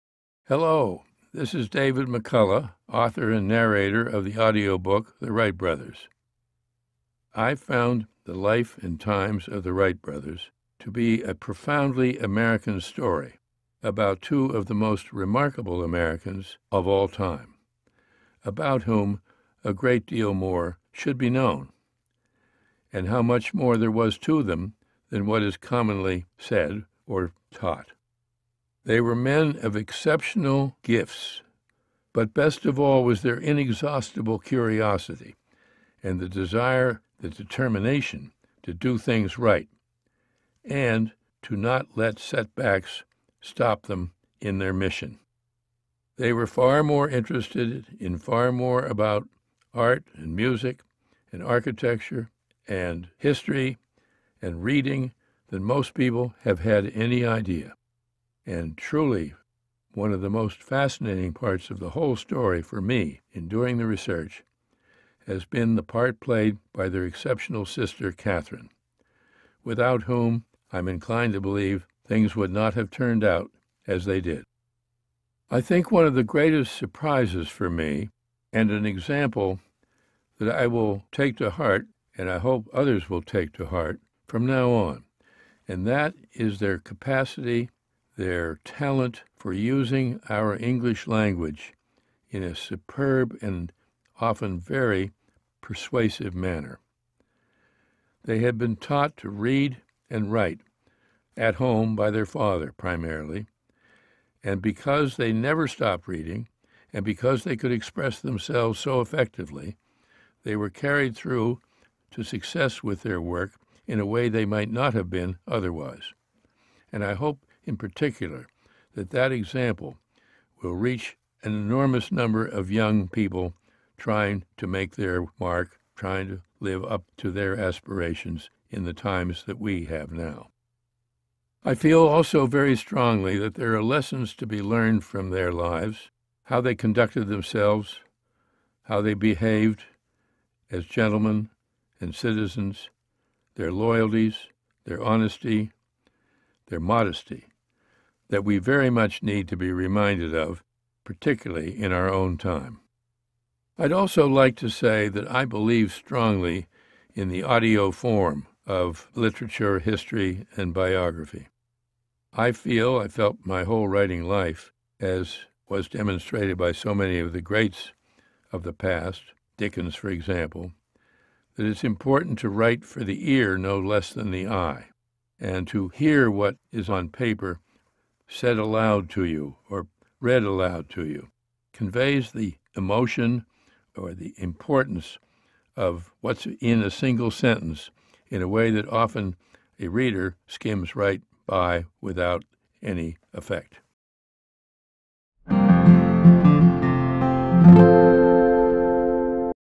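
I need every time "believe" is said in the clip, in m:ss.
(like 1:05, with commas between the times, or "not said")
1:11, 2:35.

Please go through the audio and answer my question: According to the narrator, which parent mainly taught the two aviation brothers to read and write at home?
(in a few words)
Their father.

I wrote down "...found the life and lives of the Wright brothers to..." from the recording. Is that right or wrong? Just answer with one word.
wrong.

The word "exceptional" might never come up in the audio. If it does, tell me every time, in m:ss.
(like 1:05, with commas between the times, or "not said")
0:29, 1:07.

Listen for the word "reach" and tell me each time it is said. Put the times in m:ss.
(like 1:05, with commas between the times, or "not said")
2:00.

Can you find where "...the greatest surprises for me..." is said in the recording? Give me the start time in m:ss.
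1:16.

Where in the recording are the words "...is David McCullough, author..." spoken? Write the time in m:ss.
0:01.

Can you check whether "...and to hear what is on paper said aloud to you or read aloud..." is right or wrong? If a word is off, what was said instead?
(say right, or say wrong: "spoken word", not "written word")
right.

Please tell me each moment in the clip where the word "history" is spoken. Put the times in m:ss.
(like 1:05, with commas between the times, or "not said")
0:53, 2:39.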